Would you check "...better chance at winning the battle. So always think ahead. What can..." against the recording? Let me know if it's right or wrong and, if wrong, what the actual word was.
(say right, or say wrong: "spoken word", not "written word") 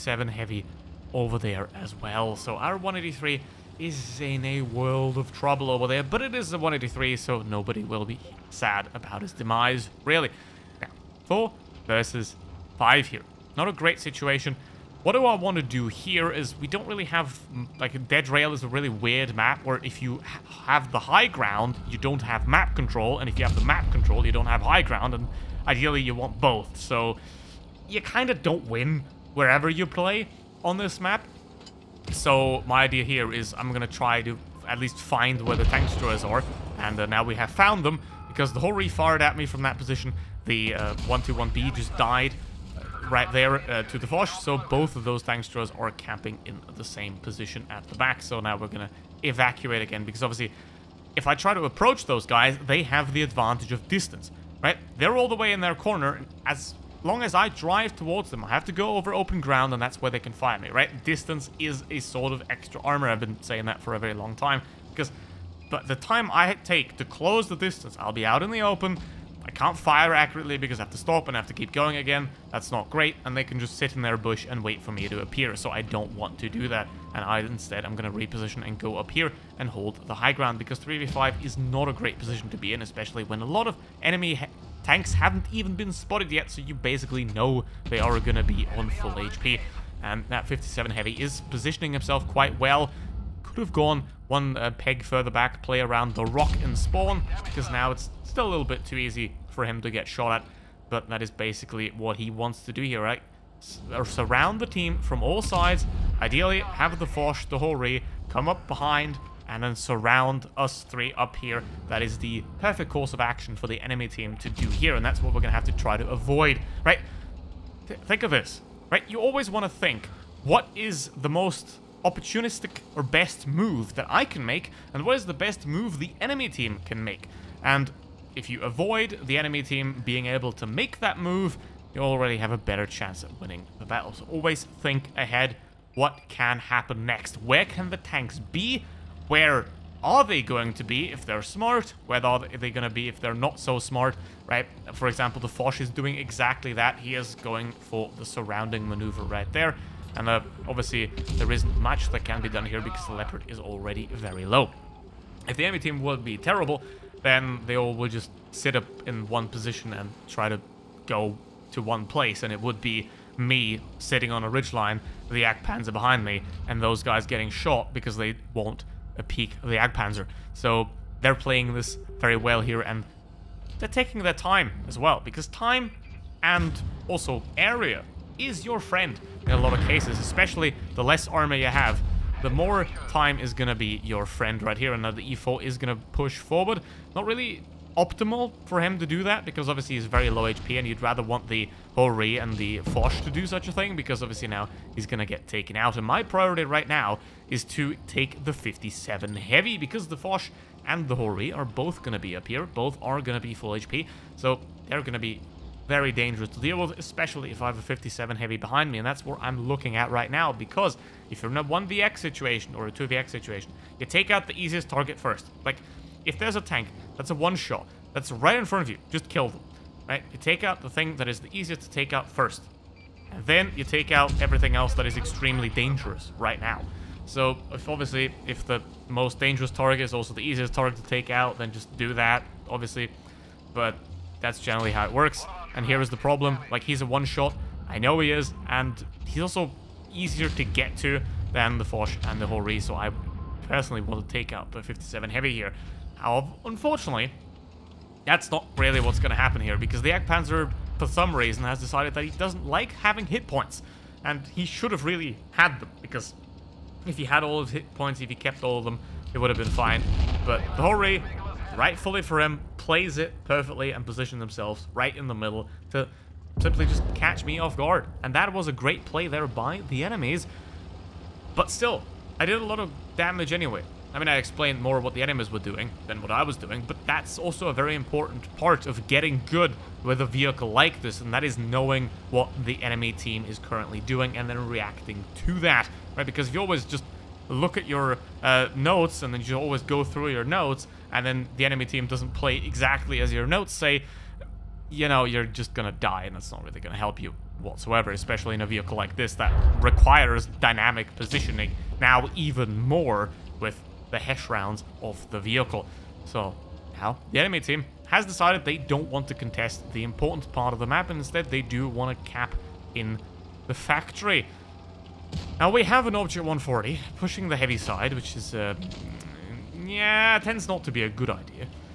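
right.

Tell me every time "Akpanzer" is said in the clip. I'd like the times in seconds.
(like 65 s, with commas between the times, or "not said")
165 s.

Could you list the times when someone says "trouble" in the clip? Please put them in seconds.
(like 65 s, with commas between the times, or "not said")
5 s.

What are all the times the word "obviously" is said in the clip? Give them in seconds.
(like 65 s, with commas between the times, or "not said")
50 s, 150 s, 189 s, 194 s, 227 s, 232 s.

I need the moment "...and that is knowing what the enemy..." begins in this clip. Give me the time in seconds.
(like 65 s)
281 s.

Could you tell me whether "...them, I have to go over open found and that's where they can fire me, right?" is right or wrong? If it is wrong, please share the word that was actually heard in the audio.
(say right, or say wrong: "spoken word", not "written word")
wrong: "ground", not "found".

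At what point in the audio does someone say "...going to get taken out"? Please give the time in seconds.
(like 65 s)
195 s.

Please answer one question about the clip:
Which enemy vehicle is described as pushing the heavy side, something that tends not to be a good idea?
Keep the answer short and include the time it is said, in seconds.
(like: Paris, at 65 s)
Object 140, at 316 s.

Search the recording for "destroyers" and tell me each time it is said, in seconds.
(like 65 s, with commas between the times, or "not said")
35 s, 45 s.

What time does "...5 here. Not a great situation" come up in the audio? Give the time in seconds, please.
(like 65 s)
12 s.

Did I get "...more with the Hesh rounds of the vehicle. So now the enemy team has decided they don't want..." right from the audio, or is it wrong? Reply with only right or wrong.
right.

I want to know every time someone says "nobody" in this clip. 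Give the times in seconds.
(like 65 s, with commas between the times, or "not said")
7 s.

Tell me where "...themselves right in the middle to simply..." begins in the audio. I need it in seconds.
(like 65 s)
264 s.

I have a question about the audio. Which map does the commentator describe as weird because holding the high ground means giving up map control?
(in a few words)
Dead Rail.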